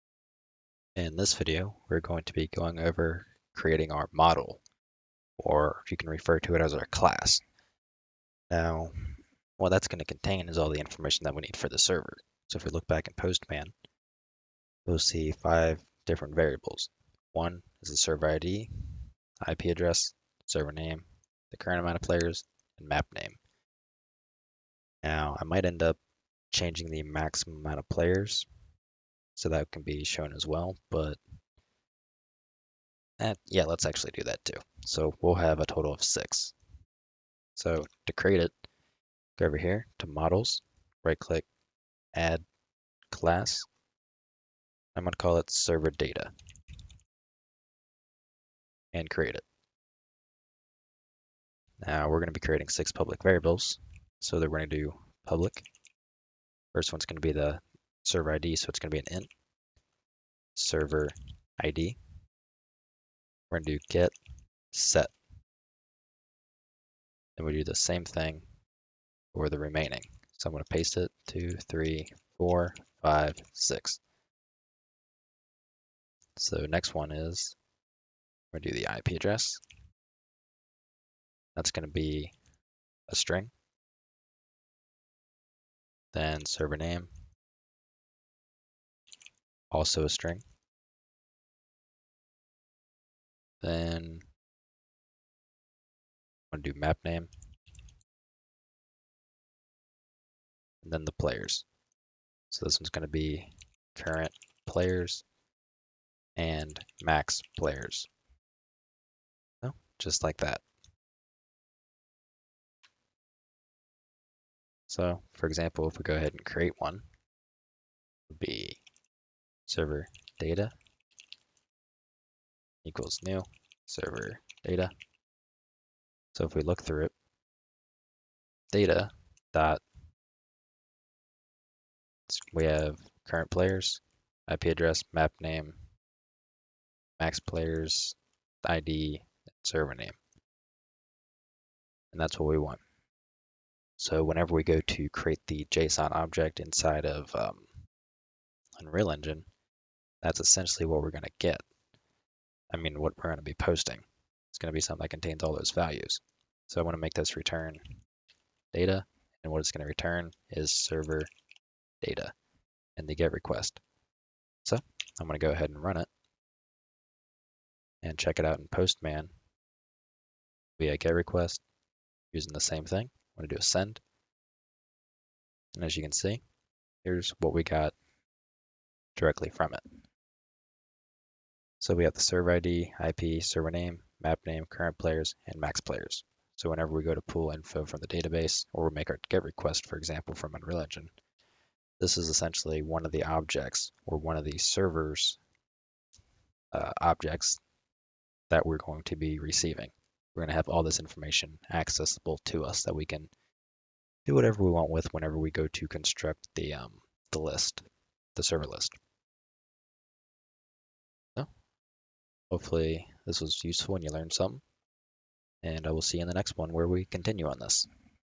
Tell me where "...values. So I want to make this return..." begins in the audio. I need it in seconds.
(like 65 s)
155 s.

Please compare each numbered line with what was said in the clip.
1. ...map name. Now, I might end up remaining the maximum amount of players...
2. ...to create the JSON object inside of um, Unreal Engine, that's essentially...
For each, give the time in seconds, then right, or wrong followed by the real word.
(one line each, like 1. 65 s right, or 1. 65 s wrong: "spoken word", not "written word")
1. 22 s wrong: "changing", not "remaining"
2. 144 s right.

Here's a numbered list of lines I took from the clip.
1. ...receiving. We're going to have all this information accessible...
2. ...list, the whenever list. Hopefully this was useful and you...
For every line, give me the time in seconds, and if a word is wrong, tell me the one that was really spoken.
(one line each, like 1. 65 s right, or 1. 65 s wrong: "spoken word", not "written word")
1. 199 s right
2. 207 s wrong: "server", not "whenever".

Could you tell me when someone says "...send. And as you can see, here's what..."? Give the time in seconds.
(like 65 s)
173 s.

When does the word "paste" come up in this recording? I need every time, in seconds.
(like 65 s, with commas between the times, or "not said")
70 s.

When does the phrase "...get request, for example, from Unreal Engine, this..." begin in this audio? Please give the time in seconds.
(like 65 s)
189 s.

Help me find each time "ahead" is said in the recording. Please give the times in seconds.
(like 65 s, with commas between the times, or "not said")
116 s, 165 s.